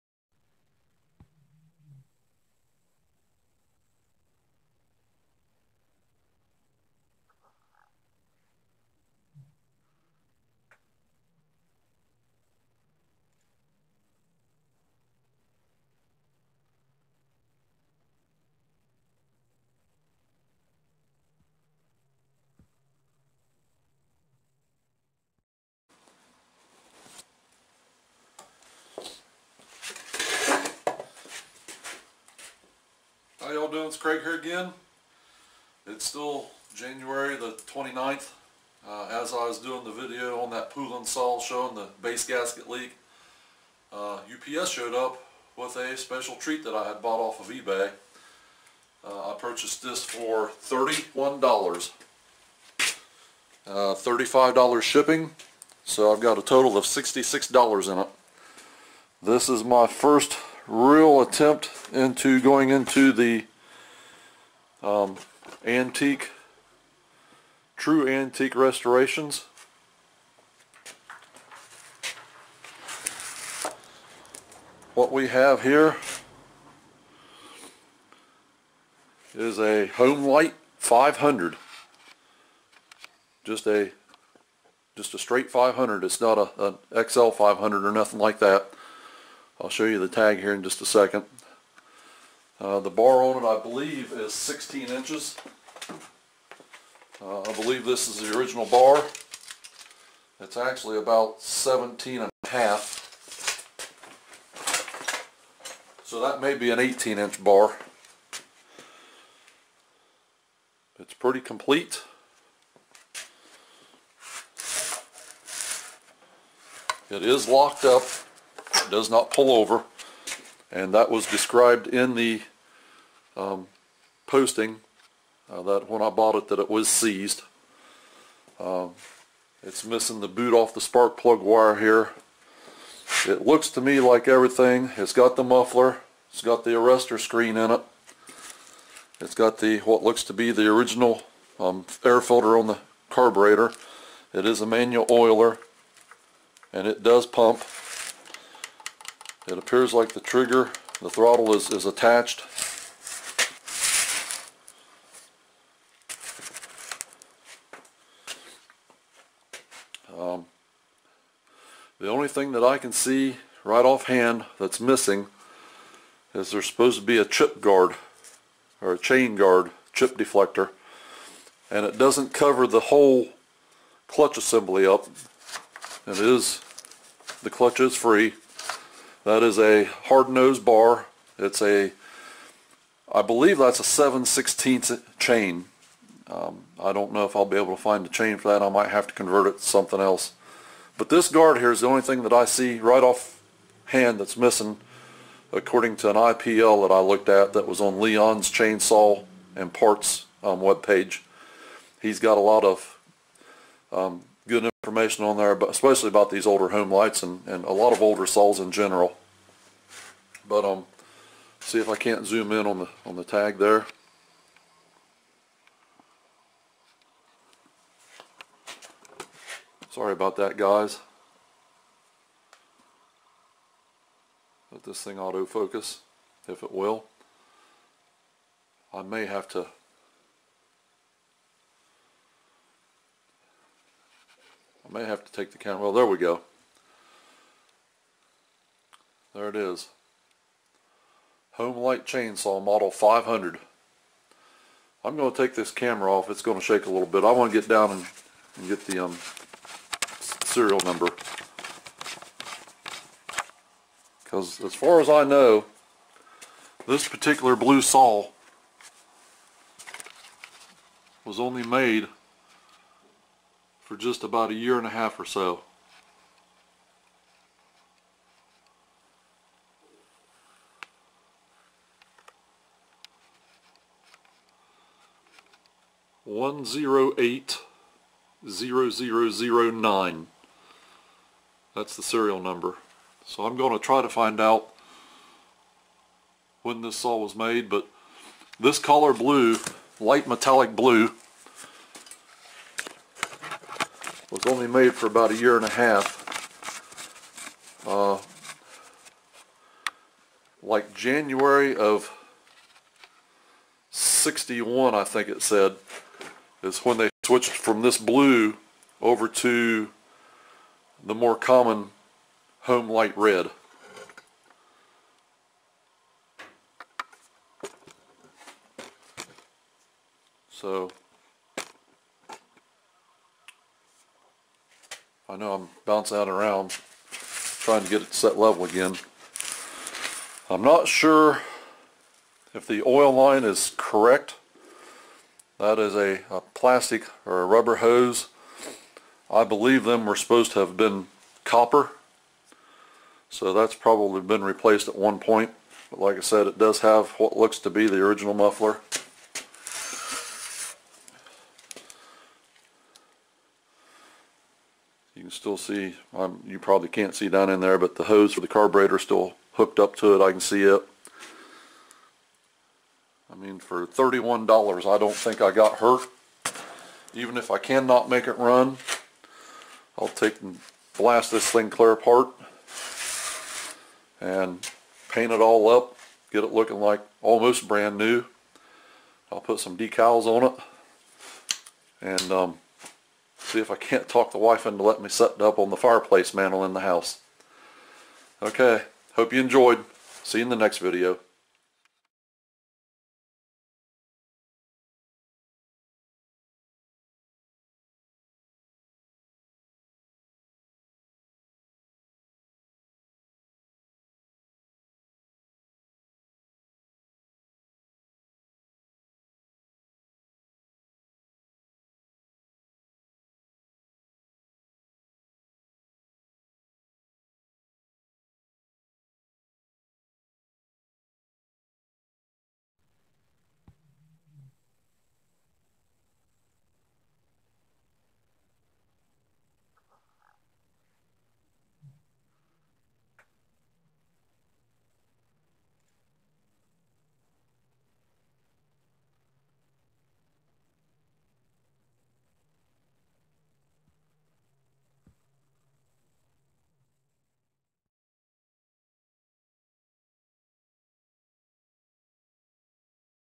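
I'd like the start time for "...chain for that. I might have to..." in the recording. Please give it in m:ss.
3:08.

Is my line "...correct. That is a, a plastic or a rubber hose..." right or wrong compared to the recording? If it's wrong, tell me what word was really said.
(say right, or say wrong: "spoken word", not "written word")
right.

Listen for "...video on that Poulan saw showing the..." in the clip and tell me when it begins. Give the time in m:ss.
0:39.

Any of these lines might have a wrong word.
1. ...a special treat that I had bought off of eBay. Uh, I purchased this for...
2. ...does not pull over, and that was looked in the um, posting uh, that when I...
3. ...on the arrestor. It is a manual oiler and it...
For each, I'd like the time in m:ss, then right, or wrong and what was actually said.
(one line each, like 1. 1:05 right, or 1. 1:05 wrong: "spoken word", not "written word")
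1. 0:45 right
2. 1:58 wrong: "described", not "looked"
3. 2:22 wrong: "carburetor", not "arrestor".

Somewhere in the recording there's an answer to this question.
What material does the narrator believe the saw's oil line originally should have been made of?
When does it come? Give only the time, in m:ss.
5:41.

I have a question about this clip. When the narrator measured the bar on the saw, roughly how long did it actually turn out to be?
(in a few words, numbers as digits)
17 and a half inches.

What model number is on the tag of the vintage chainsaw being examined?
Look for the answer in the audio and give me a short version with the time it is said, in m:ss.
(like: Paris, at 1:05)
500, at 4:01.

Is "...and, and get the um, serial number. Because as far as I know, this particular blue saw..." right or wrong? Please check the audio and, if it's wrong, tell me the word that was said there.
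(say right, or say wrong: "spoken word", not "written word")
right.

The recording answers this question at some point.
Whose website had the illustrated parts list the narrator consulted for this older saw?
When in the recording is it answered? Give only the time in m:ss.
3:17.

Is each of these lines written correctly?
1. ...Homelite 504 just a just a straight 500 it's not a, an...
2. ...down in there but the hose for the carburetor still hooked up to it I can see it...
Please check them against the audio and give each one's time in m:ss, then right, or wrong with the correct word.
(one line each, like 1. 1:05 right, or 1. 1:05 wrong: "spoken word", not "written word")
1. 1:19 wrong: "500", not "504"
2. 5:57 right.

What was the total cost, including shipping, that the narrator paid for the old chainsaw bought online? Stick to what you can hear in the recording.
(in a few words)
$66.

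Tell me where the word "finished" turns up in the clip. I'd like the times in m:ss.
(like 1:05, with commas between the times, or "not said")
not said.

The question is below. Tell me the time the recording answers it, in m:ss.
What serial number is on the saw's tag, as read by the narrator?
4:36.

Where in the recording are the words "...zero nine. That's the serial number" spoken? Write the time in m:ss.
4:39.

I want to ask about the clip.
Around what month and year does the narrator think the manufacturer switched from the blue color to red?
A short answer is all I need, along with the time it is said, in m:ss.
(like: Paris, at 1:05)
January 1961, at 5:00.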